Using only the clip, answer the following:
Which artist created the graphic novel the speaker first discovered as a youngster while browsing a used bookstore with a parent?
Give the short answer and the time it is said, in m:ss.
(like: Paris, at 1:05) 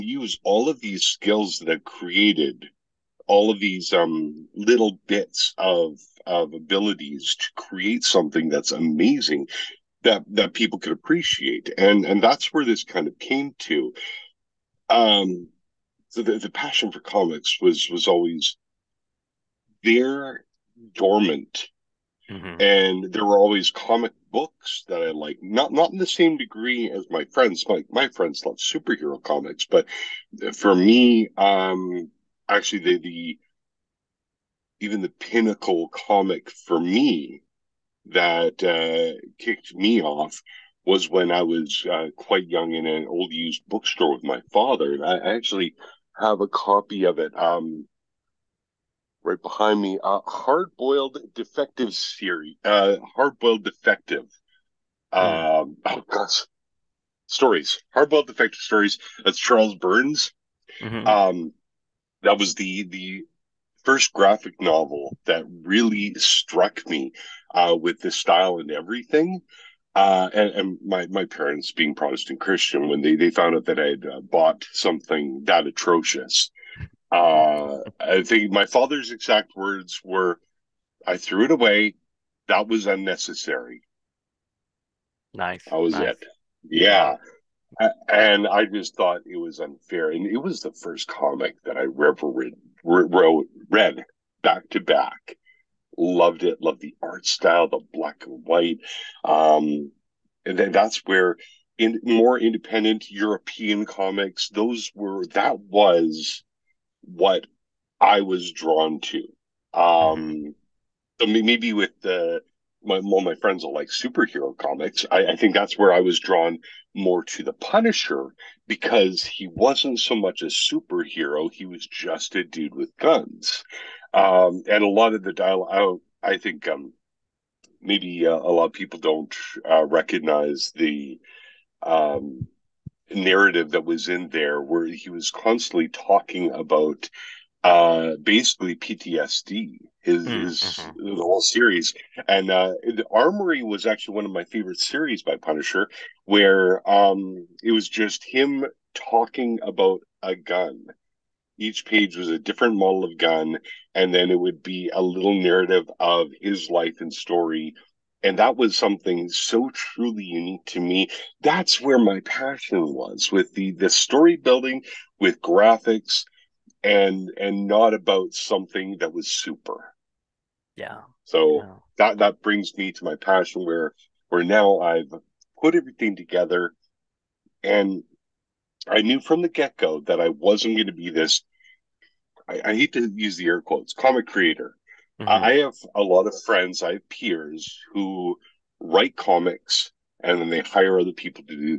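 Charles Burns, at 0:59.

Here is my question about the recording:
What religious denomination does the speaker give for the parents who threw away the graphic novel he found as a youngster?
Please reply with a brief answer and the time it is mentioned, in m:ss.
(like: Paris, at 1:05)
Protestant Christian, at 1:11.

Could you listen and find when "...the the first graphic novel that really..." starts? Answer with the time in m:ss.
1:02.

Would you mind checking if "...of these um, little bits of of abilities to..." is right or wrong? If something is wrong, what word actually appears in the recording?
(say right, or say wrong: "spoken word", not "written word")
right.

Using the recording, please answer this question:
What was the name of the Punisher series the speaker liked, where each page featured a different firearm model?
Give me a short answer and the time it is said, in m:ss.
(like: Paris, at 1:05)
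The Armory, at 2:22.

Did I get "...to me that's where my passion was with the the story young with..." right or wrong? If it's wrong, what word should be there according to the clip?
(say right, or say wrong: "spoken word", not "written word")
wrong: "building", not "young".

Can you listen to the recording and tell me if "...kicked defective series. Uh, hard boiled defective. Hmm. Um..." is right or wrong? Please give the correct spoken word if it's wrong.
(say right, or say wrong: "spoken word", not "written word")
wrong: "boiled", not "kicked".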